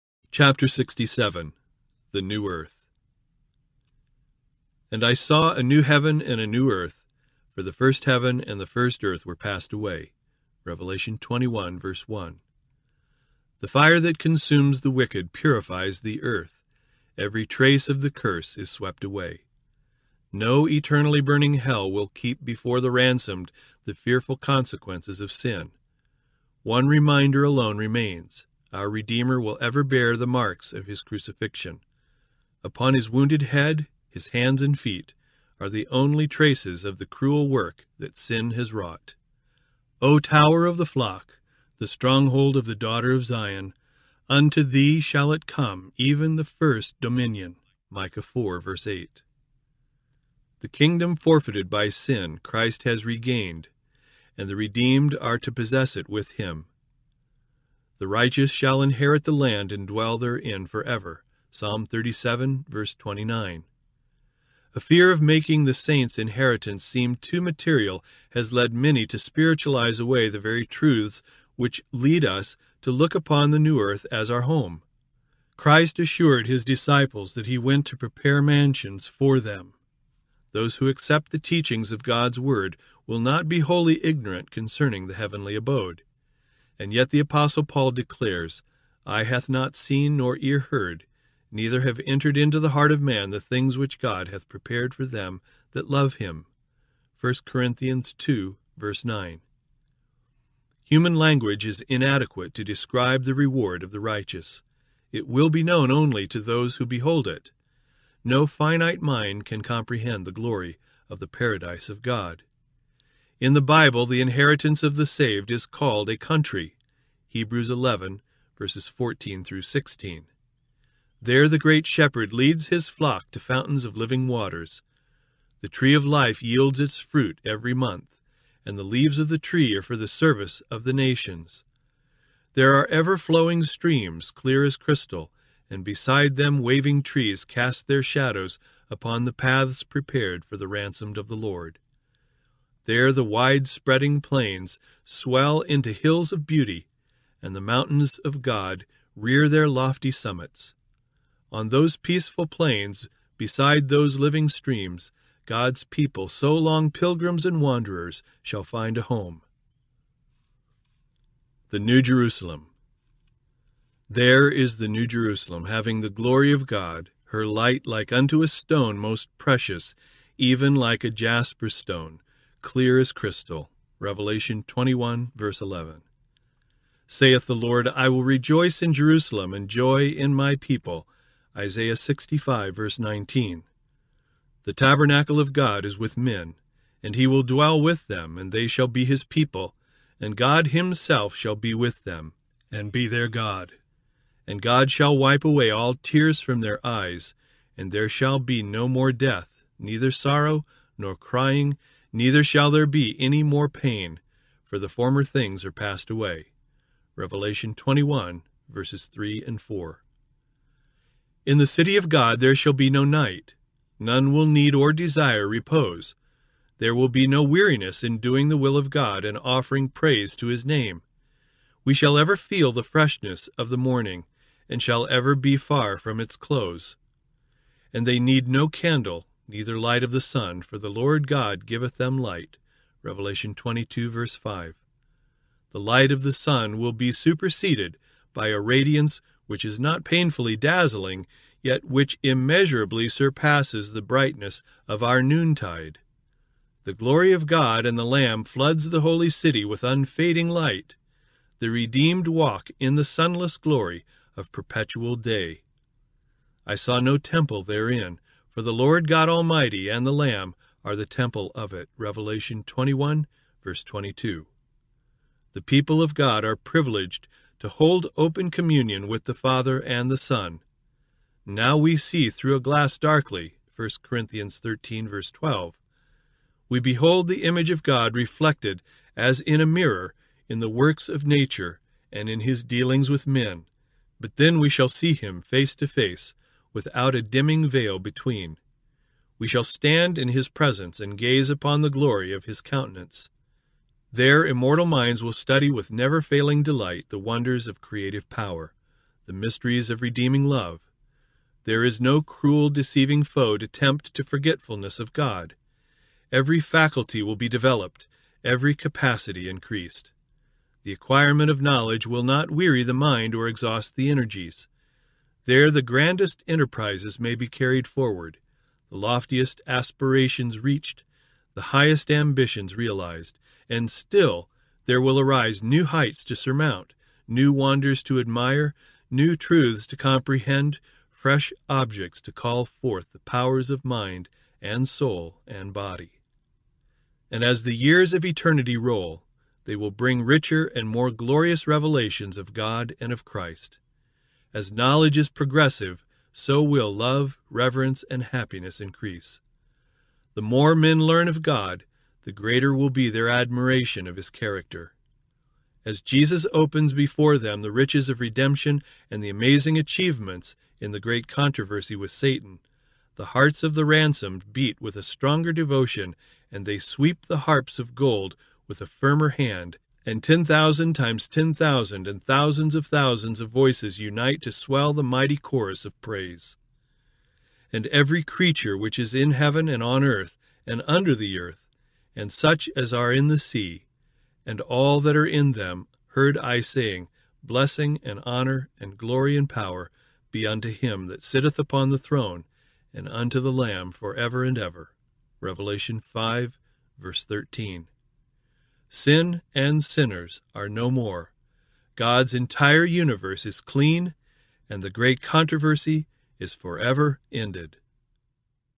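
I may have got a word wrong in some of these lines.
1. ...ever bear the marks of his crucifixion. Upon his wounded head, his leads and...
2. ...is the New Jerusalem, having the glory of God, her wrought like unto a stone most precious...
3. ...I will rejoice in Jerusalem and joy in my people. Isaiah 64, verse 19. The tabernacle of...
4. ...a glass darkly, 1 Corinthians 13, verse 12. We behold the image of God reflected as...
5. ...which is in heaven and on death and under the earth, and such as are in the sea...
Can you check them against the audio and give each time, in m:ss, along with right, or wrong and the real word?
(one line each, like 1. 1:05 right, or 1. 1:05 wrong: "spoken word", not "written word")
1. 0:29 wrong: "hands", not "leads"
2. 2:44 wrong: "light", not "wrought"
3. 2:57 wrong: "65", not "64"
4. 4:32 right
5. 6:18 wrong: "earth", not "death".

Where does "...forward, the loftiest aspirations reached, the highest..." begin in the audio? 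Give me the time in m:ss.
5:17.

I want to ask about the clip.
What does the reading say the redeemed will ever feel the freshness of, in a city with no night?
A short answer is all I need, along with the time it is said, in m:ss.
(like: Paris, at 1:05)
The morning, at 3:43.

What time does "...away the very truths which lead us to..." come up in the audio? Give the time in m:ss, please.
1:09.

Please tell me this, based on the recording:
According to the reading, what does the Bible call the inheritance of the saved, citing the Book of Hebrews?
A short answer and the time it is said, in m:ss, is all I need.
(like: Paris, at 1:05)
A country, at 1:56.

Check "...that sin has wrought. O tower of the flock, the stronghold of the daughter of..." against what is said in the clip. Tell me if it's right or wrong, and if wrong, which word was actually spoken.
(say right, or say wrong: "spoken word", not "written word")
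right.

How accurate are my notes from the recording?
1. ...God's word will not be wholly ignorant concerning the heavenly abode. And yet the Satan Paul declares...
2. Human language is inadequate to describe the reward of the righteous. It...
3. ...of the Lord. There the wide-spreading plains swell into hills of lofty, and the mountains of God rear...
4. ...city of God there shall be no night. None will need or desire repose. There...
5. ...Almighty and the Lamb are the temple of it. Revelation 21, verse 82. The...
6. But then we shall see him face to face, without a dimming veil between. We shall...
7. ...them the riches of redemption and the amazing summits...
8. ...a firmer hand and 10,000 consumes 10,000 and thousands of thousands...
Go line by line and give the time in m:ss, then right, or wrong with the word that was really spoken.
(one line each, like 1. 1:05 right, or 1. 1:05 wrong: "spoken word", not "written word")
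1. 1:22 wrong: "Apostle", not "Satan"
2. 1:40 right
3. 2:21 wrong: "beauty", not "lofty"
4. 3:31 right
5. 4:19 wrong: "22", not "82"
6. 4:44 right
7. 5:57 wrong: "achievements", not "summits"
8. 6:08 wrong: "times", not "consumes".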